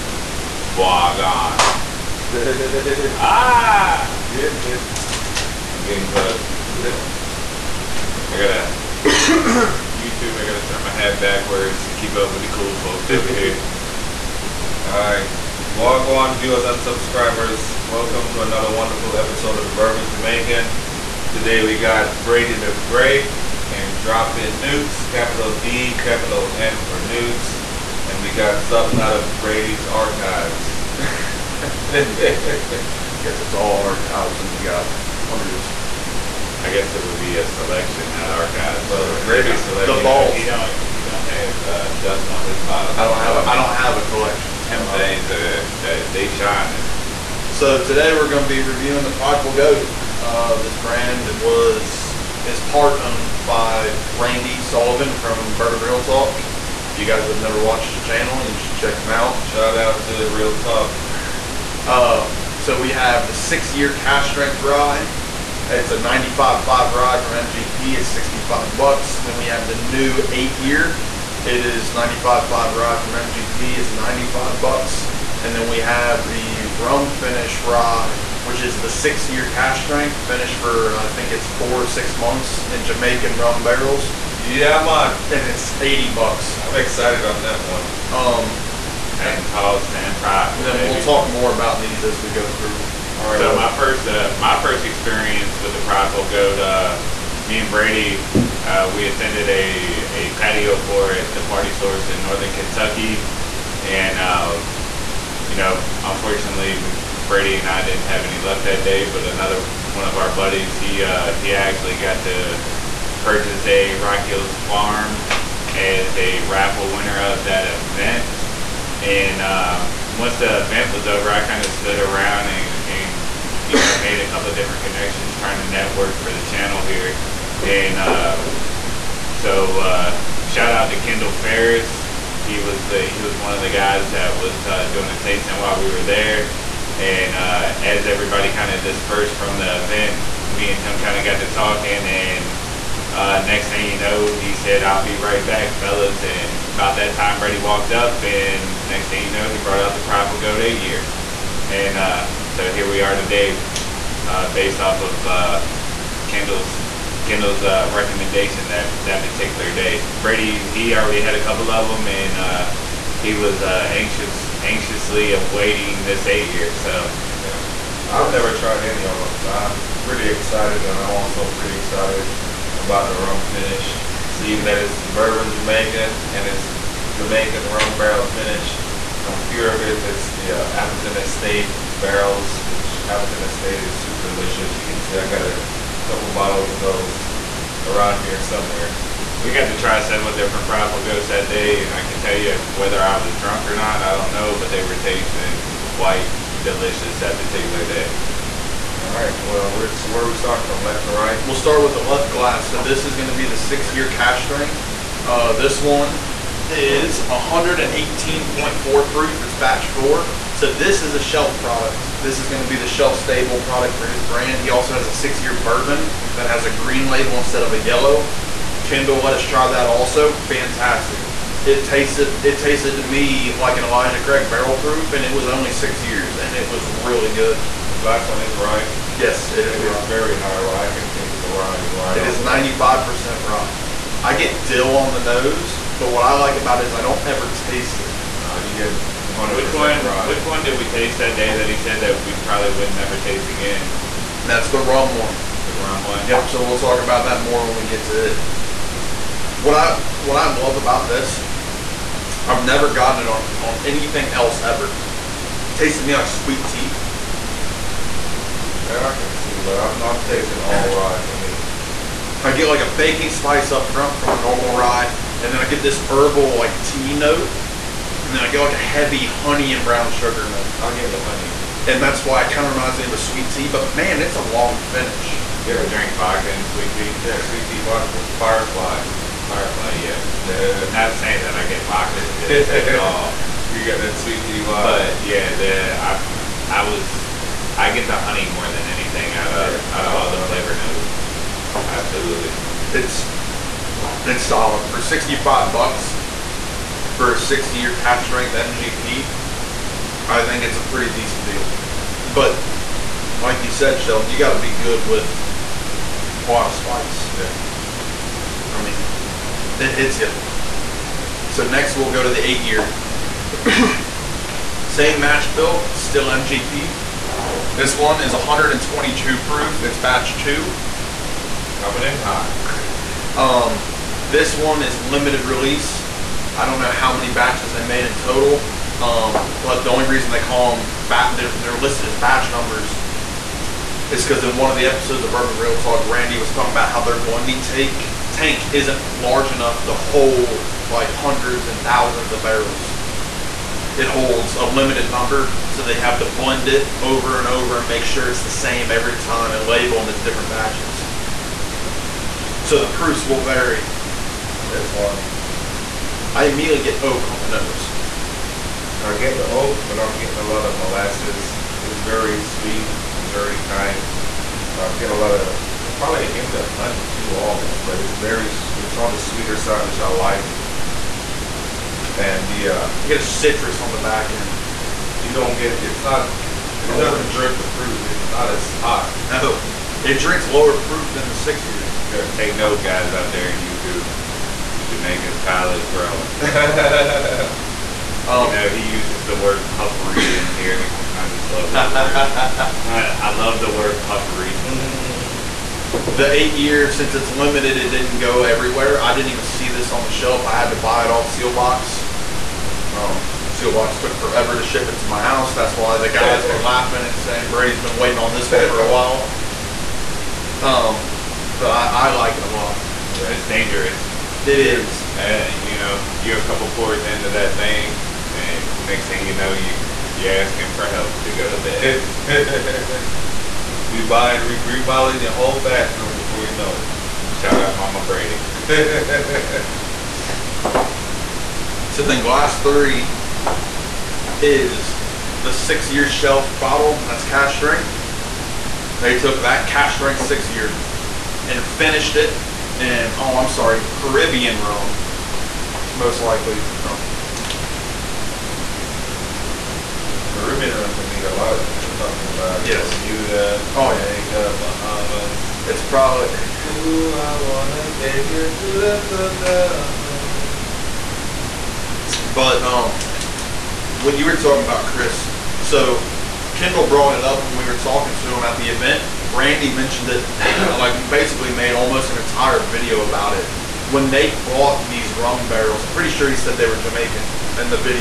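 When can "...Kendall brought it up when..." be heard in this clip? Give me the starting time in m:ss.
7:46.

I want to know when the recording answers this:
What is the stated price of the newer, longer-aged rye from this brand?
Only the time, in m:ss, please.
1:13.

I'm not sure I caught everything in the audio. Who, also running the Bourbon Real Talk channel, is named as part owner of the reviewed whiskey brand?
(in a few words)
Randy Sullivan.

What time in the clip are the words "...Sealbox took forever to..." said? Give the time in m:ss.
6:43.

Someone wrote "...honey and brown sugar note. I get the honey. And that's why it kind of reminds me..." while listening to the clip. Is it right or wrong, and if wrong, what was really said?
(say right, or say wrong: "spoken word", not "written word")
right.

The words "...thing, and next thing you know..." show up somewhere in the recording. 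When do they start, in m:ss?
6:57.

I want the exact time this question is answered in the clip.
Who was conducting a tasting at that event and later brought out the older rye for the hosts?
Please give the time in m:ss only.
2:10.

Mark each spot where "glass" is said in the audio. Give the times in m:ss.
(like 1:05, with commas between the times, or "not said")
3:22, 3:47, 7:12.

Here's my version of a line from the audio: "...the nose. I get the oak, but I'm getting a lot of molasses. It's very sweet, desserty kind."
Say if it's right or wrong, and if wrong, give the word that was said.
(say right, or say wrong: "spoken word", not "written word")
right.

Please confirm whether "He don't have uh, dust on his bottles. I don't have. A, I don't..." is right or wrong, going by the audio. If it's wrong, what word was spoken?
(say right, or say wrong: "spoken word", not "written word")
right.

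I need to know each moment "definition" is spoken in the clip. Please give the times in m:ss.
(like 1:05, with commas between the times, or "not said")
not said.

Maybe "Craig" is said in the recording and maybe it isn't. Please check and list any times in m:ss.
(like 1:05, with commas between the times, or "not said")
3:44.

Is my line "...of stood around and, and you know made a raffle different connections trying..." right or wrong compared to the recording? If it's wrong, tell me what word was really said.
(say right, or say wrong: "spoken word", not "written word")
wrong: "couple", not "raffle".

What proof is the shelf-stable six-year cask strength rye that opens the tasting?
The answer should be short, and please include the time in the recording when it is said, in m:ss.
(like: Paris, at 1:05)
118.4, at 3:27.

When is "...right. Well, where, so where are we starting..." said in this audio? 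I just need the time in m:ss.
3:19.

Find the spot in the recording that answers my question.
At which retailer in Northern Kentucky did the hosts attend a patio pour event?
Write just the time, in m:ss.
1:41.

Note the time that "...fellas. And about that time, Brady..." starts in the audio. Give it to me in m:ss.
2:25.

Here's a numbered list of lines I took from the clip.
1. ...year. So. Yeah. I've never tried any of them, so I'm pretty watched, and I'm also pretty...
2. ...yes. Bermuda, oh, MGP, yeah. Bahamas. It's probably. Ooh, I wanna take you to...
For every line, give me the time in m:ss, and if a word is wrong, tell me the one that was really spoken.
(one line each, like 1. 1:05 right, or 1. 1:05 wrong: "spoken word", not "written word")
1. 2:46 wrong: "excited", not "watched"
2. 7:32 wrong: "Jamaica", not "MGP".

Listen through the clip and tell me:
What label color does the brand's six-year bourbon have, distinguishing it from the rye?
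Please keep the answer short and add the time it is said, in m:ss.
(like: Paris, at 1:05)
Green, at 3:36.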